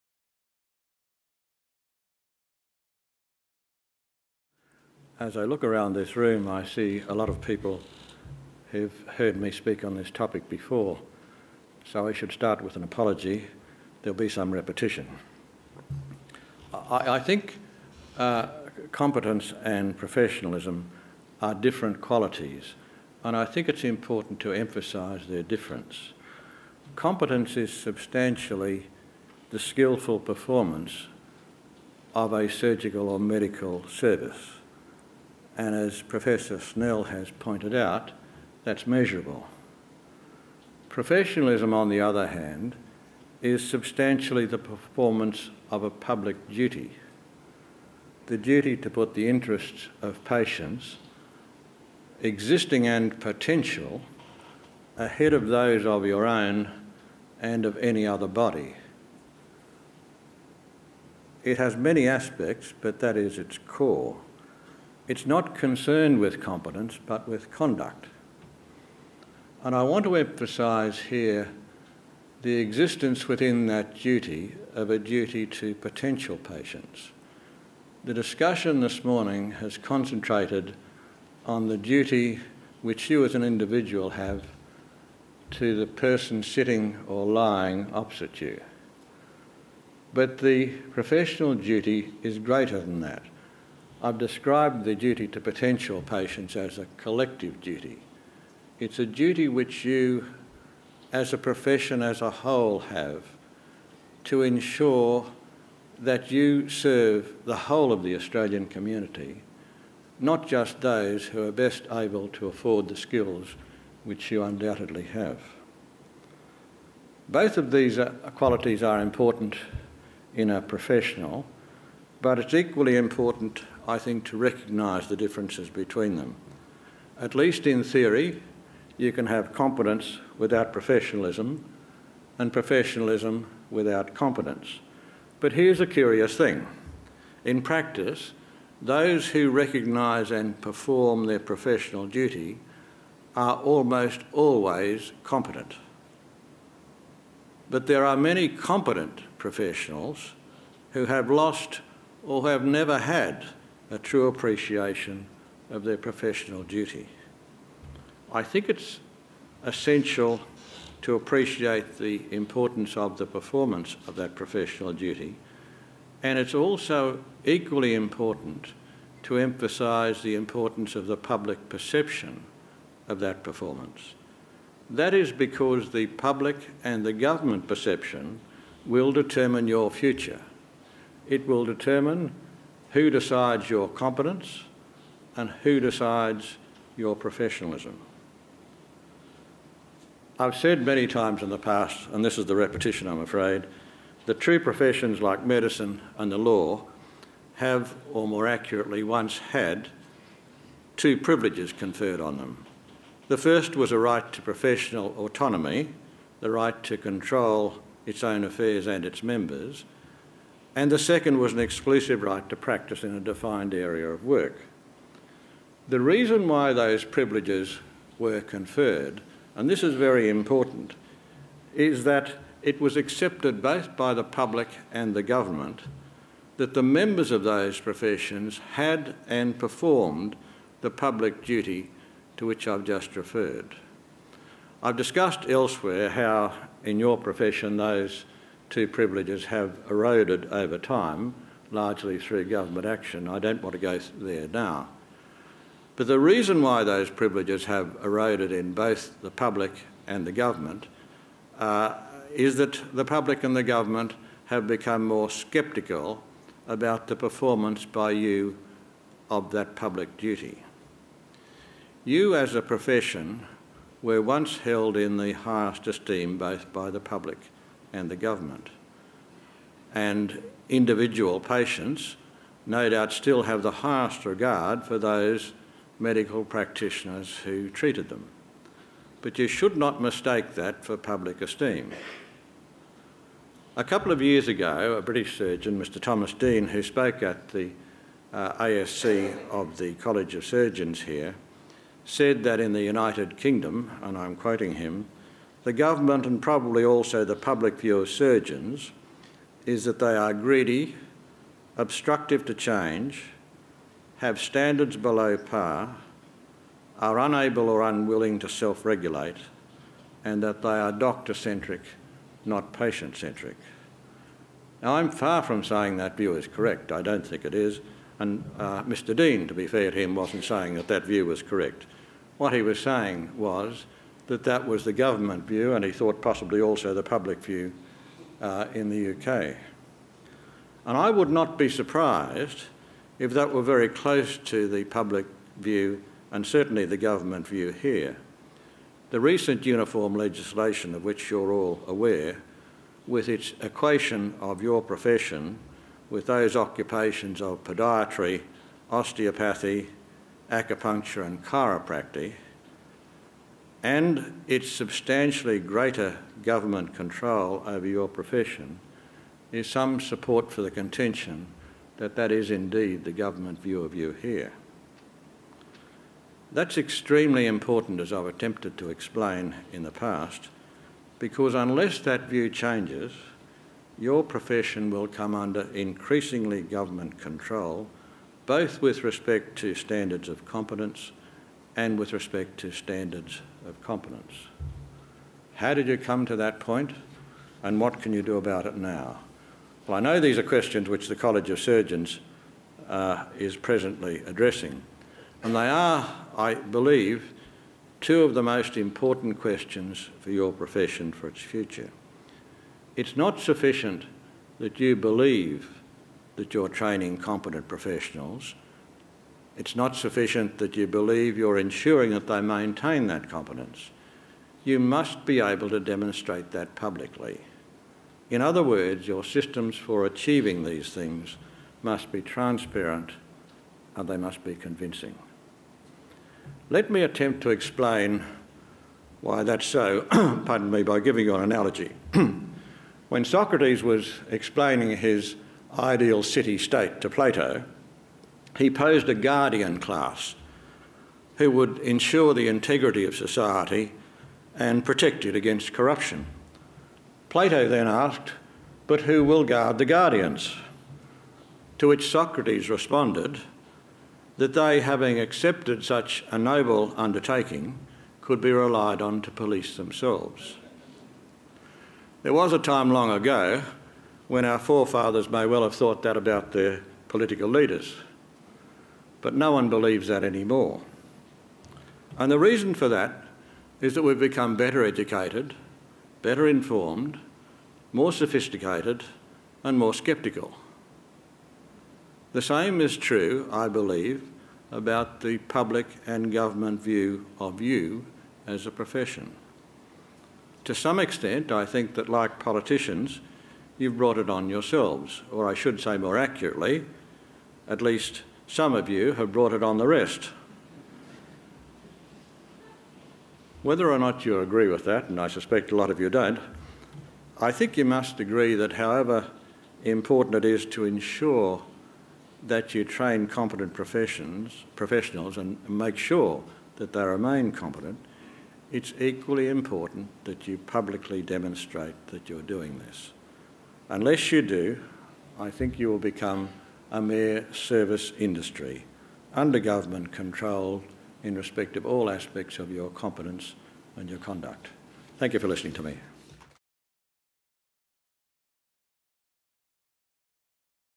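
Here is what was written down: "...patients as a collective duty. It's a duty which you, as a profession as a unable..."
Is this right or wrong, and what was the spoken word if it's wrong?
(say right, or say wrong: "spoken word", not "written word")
wrong: "whole", not "unable".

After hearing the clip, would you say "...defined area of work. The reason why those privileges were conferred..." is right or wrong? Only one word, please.
right.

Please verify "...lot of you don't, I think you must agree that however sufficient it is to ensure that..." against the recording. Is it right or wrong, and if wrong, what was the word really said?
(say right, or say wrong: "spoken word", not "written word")
wrong: "important", not "sufficient".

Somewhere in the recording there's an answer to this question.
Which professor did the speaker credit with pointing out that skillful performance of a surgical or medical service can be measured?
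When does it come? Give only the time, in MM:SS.
00:36.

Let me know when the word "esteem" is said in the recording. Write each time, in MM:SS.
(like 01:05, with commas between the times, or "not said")
04:25, 04:41.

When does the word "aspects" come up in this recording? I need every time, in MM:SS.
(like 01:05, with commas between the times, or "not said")
01:02, 08:52.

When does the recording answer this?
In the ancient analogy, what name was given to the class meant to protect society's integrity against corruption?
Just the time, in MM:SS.
07:19.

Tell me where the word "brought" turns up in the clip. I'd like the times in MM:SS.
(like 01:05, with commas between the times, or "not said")
08:13, 08:19.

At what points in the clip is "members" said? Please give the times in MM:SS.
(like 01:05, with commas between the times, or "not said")
03:29, 03:46.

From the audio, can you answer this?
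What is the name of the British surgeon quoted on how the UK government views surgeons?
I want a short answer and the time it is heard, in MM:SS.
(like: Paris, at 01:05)
Thomas Dean, at 04:45.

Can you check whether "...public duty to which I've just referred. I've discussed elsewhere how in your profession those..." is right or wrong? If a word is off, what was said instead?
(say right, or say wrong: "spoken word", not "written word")
right.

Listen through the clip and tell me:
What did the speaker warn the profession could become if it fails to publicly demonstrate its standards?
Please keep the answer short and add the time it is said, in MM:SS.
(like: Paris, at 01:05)
a mere service industry, at 08:46.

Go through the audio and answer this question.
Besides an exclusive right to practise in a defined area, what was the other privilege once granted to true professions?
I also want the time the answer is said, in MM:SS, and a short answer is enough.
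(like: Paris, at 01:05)
professional autonomy, at 03:24.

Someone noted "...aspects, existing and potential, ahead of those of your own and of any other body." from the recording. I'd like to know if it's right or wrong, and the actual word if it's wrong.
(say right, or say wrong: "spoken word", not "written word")
wrong: "patients", not "aspects".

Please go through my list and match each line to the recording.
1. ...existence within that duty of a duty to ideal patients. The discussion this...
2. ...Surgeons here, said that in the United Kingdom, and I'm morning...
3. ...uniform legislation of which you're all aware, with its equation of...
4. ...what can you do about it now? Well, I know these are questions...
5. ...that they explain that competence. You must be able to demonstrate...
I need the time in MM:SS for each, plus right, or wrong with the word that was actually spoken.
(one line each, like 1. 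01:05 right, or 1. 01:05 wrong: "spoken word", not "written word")
1. 01:12 wrong: "potential", not "ideal"
2. 04:50 wrong: "quoting", not "morning"
3. 05:39 right
4. 06:27 right
5. 06:52 wrong: "maintain", not "explain".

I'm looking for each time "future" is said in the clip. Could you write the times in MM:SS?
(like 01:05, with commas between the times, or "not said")
02:59, 06:41.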